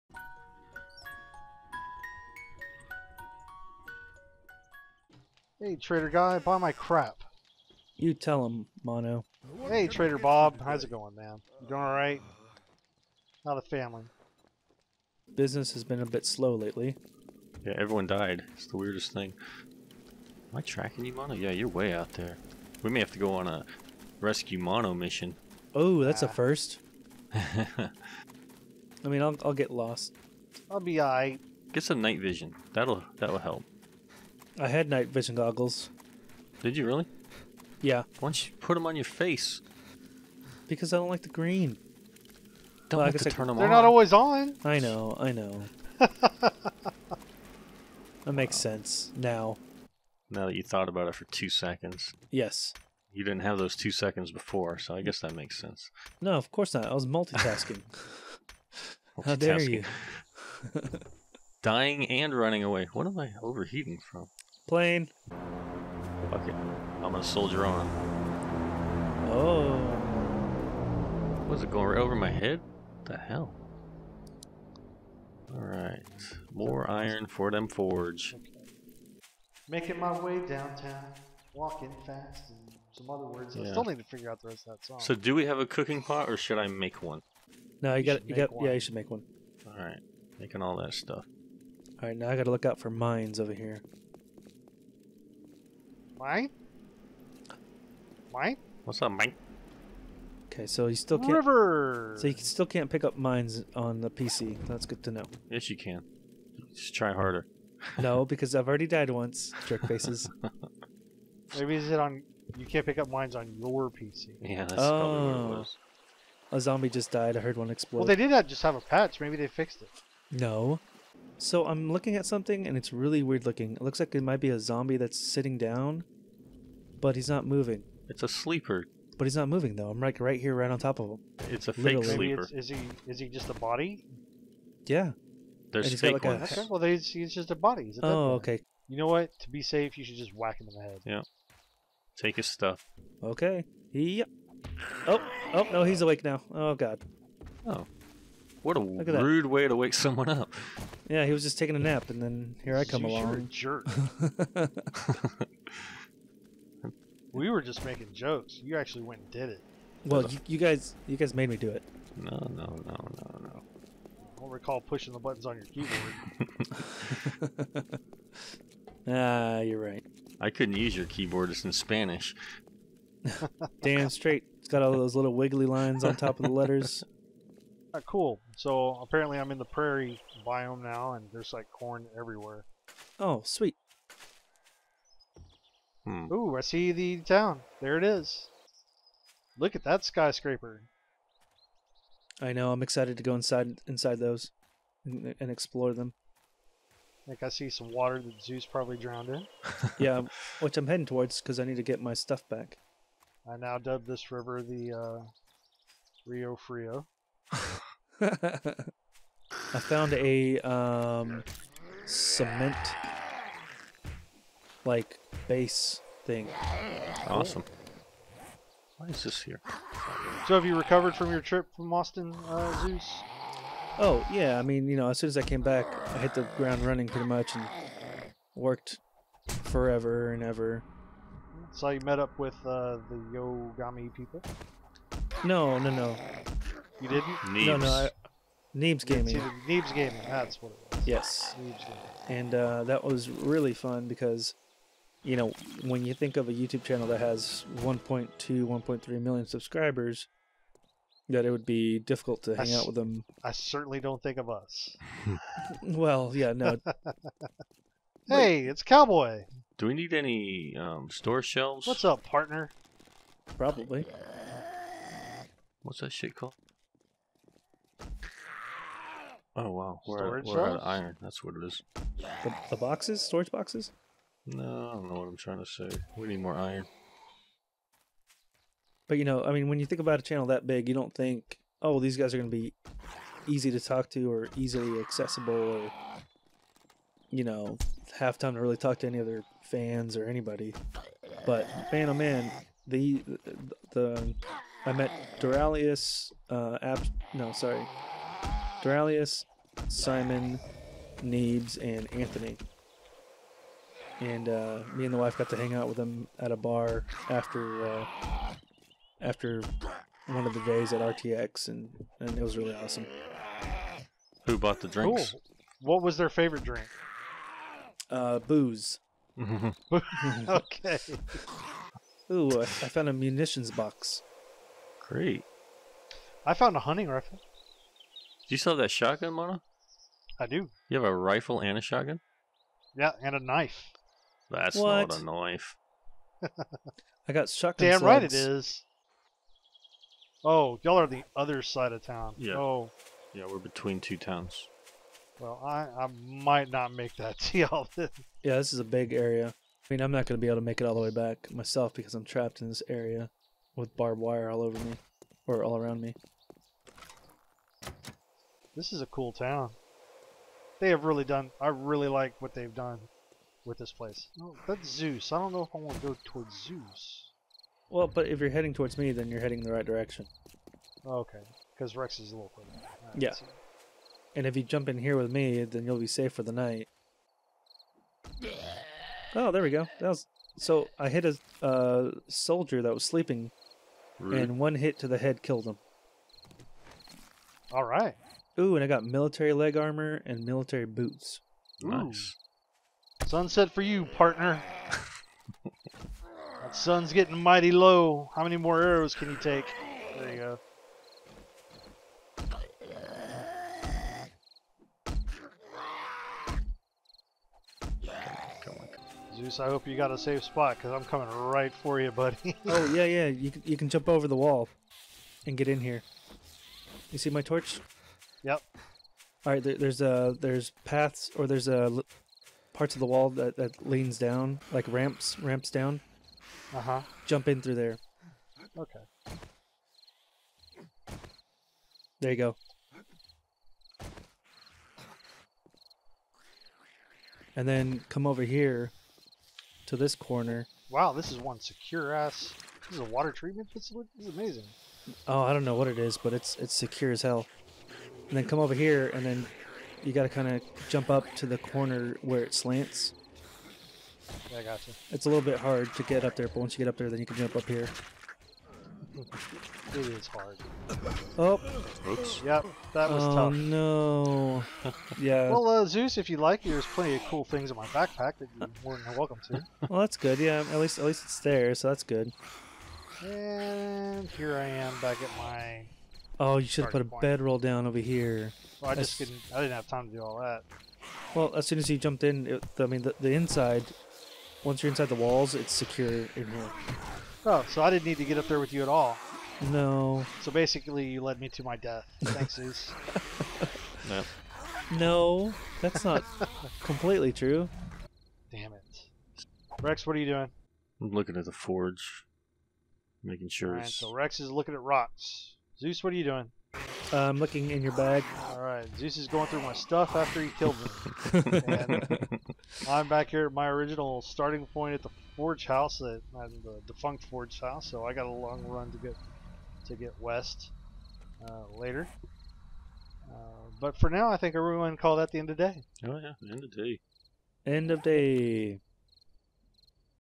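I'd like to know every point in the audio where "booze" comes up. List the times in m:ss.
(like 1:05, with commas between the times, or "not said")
5:18.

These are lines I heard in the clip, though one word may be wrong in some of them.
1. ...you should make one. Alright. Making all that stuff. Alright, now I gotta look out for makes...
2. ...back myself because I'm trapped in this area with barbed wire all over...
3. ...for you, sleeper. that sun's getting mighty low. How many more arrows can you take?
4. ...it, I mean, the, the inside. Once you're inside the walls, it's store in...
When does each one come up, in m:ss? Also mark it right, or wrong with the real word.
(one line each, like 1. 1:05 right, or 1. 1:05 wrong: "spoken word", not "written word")
1. 1:28 wrong: "mines", not "makes"
2. 5:51 right
3. 6:33 wrong: "partner", not "sleeper"
4. 8:02 wrong: "secure", not "store".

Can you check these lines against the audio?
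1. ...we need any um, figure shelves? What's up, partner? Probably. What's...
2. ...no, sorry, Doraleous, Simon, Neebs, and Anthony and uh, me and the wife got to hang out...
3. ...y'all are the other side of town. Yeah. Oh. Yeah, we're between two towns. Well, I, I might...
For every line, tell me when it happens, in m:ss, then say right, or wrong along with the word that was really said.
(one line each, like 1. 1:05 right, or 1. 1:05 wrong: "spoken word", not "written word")
1. 4:19 wrong: "store", not "figure"
2. 4:57 right
3. 5:40 right.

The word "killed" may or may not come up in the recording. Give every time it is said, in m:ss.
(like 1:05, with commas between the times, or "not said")
6:25, 8:30.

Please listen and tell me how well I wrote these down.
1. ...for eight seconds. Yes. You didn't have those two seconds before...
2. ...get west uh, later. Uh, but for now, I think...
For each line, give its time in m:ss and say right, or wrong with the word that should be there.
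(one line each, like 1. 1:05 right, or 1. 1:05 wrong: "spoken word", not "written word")
1. 0:51 wrong: "two", not "eight"
2. 8:39 right.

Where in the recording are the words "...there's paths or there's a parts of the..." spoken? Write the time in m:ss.
7:00.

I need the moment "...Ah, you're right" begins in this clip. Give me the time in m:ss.
2:49.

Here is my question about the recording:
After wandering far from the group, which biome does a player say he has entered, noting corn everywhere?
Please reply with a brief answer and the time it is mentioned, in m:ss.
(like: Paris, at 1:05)
Prairie, at 2:59.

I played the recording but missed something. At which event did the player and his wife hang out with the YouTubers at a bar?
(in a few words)
RTX.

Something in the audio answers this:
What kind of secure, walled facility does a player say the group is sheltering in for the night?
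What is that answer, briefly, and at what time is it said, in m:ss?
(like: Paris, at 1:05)
Water treatment facility, at 7:23.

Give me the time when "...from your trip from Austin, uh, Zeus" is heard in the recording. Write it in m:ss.
3:41.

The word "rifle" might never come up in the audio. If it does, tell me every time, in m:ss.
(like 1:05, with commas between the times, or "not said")
5:27, 5:31.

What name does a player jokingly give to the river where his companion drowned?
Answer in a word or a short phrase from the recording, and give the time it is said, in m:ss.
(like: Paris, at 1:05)
Rio Frio, at 3:26.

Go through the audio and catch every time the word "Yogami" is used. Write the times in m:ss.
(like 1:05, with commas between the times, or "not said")
3:53.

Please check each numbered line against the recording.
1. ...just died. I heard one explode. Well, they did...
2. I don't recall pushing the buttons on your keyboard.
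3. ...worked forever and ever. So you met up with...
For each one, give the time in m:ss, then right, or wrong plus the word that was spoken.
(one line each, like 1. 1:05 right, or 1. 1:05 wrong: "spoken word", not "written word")
1. 1:56 right
2. 2:43 right
3. 3:48 right.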